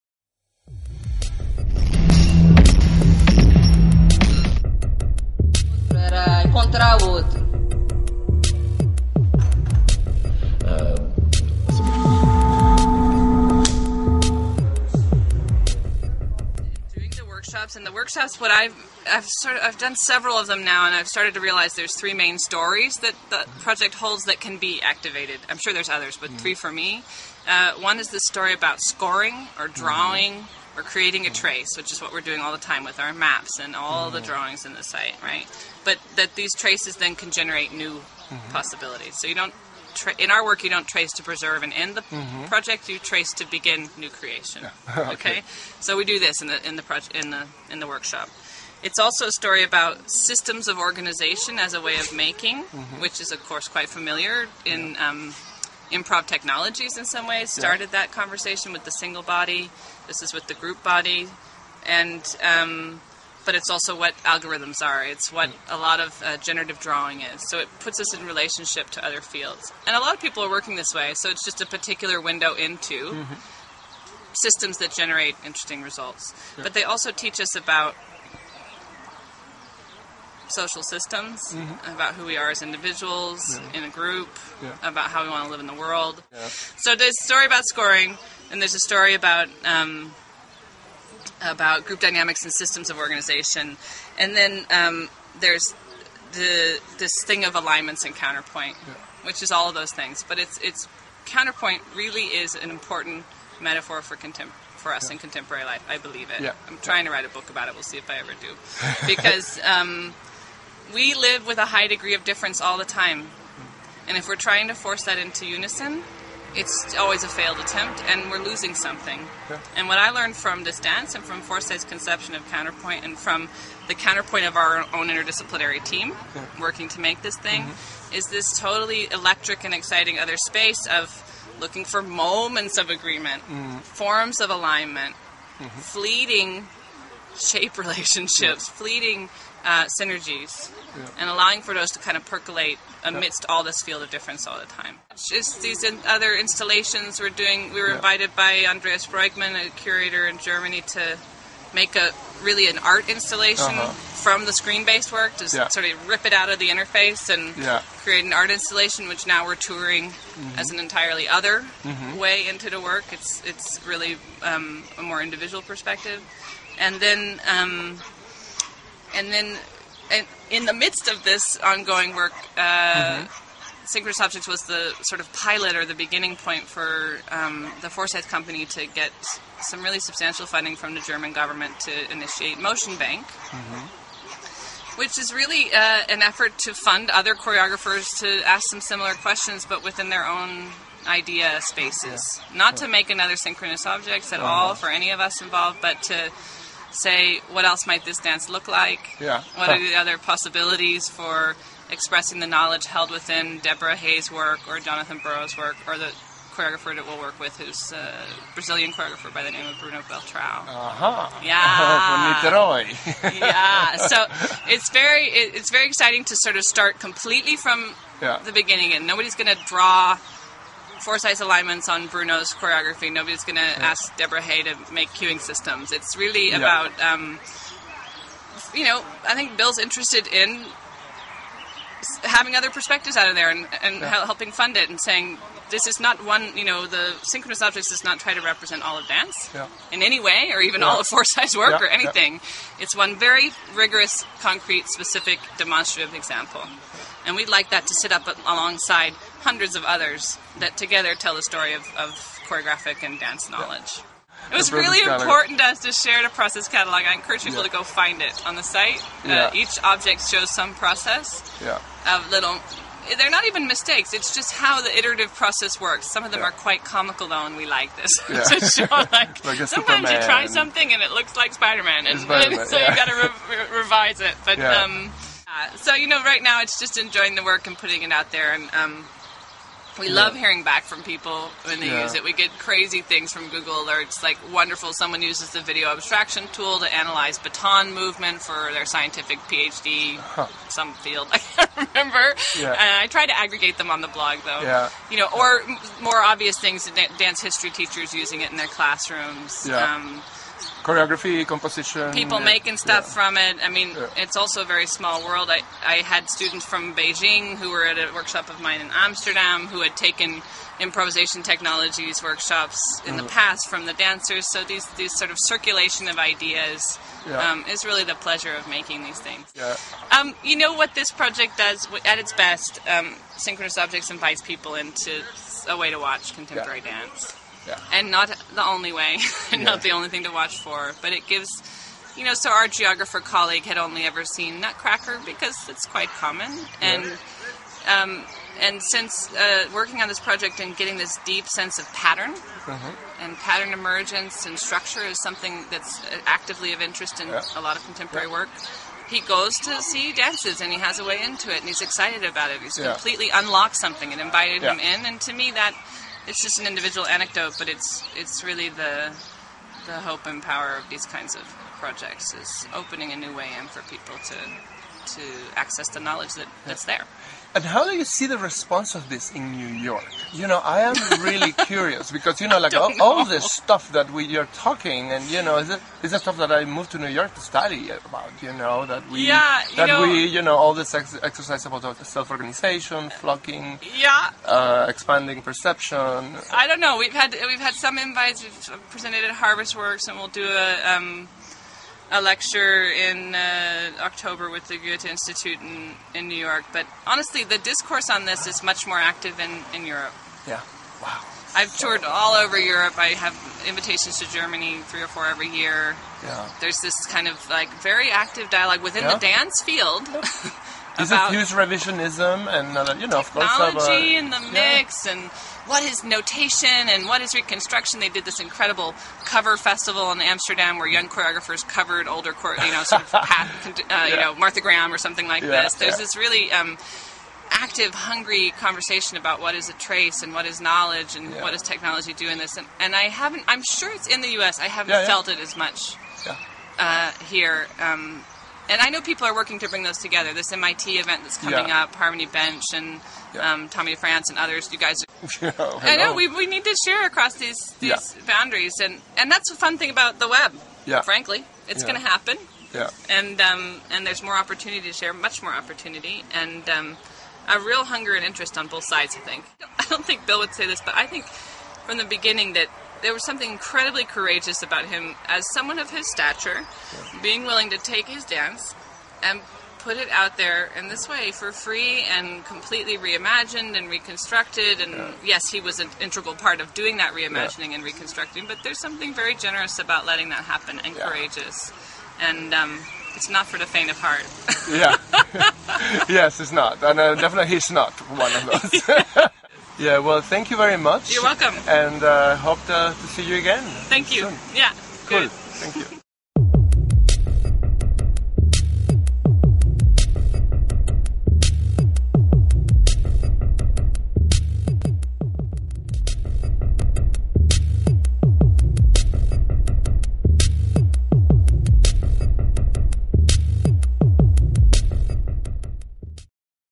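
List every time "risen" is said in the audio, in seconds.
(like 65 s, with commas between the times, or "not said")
not said.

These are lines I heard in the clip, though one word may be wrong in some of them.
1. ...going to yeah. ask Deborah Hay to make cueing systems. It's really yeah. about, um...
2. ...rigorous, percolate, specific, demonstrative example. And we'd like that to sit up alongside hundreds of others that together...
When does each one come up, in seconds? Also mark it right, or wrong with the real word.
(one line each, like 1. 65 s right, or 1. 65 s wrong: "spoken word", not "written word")
1. 223 s right
2. 243 s wrong: "concrete", not "percolate".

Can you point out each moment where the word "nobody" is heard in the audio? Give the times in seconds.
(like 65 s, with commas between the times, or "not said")
219 s, 223 s.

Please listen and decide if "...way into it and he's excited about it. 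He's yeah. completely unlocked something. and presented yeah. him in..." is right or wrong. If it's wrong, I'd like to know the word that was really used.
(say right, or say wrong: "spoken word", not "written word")
wrong: "invited", not "presented".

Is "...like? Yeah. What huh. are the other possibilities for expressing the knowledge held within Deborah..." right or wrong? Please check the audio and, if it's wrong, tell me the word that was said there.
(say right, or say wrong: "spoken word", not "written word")
right.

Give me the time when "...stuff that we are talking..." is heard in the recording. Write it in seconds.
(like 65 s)
373 s.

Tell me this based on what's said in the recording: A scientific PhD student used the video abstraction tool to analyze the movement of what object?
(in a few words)
baton.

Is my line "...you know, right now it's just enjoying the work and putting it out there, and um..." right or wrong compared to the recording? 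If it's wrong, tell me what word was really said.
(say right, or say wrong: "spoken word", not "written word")
right.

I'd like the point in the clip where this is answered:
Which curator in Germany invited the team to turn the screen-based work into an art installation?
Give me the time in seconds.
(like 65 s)
148 s.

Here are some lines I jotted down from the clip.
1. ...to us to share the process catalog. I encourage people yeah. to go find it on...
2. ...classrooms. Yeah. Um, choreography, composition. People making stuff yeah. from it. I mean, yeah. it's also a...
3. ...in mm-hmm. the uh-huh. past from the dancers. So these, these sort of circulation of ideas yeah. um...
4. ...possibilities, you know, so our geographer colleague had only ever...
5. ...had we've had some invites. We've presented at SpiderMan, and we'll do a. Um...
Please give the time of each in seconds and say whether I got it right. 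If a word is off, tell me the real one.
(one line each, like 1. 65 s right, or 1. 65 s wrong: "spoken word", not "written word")
1. 255 s right
2. 298 s right
3. 313 s right
4. 331 s wrong: "gives", not "possibilities"
5. 387 s wrong: "Harvestworks", not "SpiderMan".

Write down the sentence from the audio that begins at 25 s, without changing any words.
I'm sure there's others, but mm-hmm.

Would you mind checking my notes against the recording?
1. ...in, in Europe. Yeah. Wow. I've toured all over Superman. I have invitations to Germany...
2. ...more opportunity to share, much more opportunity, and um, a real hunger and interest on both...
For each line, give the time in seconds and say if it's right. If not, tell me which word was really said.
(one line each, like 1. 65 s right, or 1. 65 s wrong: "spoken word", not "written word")
1. 399 s wrong: "Europe", not "Superman"
2. 454 s right.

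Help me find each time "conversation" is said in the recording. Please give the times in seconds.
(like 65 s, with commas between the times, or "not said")
58 s, 428 s.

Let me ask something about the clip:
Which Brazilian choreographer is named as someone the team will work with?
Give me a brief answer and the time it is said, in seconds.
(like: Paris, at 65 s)
Bruno Beltrão, at 209 s.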